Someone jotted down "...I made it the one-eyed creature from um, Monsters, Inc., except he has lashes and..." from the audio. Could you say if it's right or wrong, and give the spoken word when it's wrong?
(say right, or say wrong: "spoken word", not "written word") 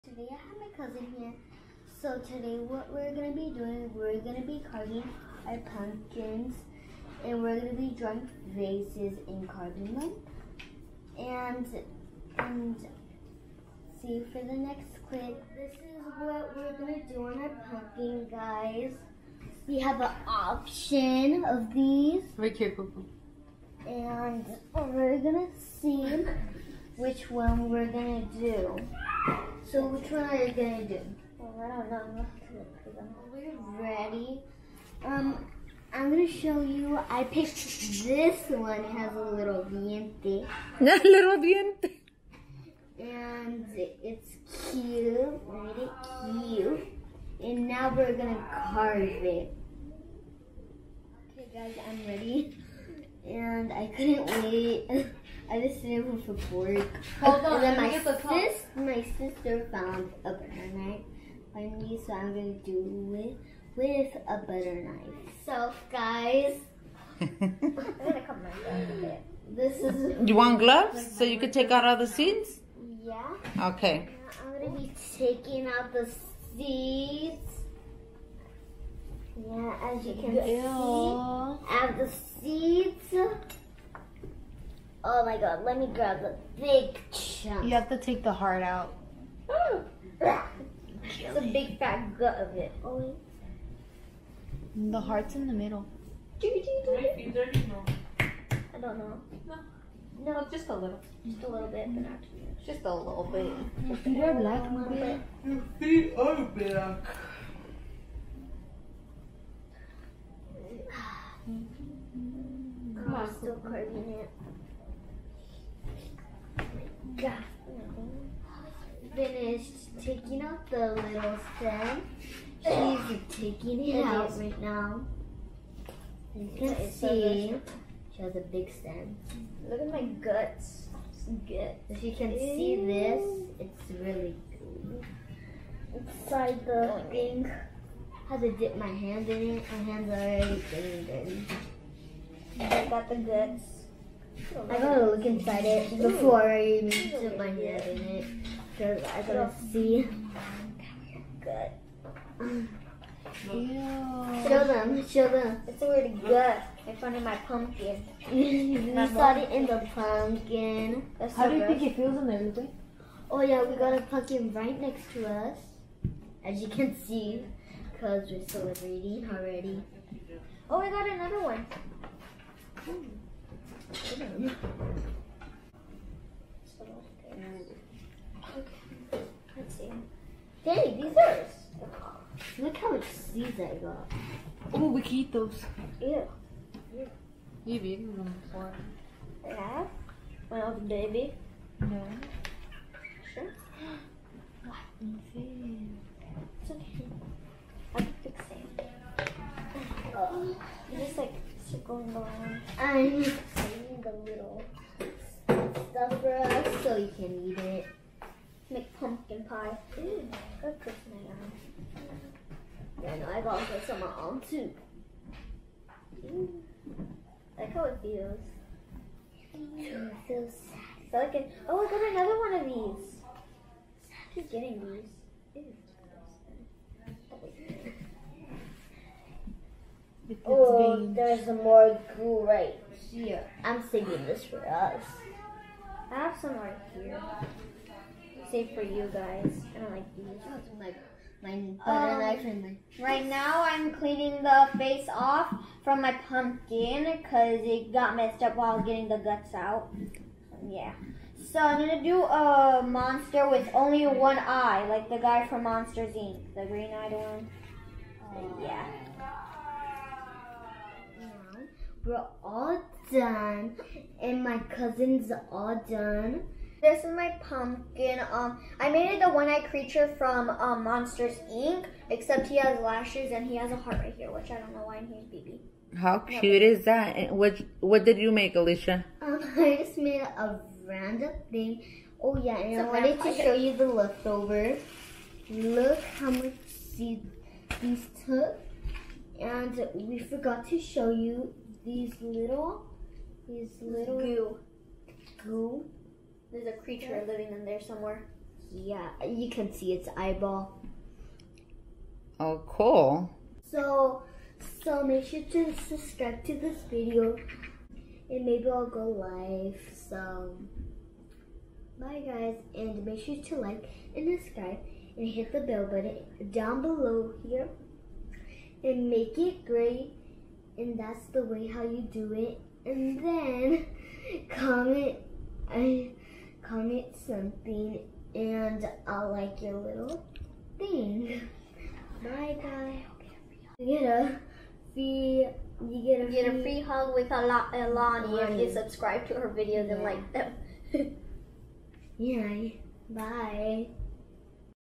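right.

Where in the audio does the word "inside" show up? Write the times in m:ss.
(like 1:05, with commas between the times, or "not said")
2:15, 2:25.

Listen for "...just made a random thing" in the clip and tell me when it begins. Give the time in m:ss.
4:39.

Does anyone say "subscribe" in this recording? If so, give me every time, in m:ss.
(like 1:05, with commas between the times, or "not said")
5:05, 5:14, 5:38.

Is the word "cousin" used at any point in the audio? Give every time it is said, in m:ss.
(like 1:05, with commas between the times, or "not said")
0:00, 4:24.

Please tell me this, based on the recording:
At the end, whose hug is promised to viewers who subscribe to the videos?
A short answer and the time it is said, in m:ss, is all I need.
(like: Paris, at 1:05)
Alani, at 5:37.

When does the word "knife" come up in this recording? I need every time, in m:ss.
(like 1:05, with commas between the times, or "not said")
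1:00, 1:04, 4:02.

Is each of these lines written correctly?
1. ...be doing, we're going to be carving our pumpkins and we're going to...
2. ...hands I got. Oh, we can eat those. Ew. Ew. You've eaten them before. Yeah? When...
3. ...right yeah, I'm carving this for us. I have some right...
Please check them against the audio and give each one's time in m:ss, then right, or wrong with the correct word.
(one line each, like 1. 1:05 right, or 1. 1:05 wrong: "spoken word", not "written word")
1. 0:03 right
2. 3:03 wrong: "seeds", not "hands"
3. 3:52 wrong: "saving", not "carving".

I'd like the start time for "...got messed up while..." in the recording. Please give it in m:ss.
4:07.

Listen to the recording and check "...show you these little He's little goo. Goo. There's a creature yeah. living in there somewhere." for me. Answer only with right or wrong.
right.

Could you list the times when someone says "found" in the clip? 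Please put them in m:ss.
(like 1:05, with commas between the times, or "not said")
0:59, 2:36.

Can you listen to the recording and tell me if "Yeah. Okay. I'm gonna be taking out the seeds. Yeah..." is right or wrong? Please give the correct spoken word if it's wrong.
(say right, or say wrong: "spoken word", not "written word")
right.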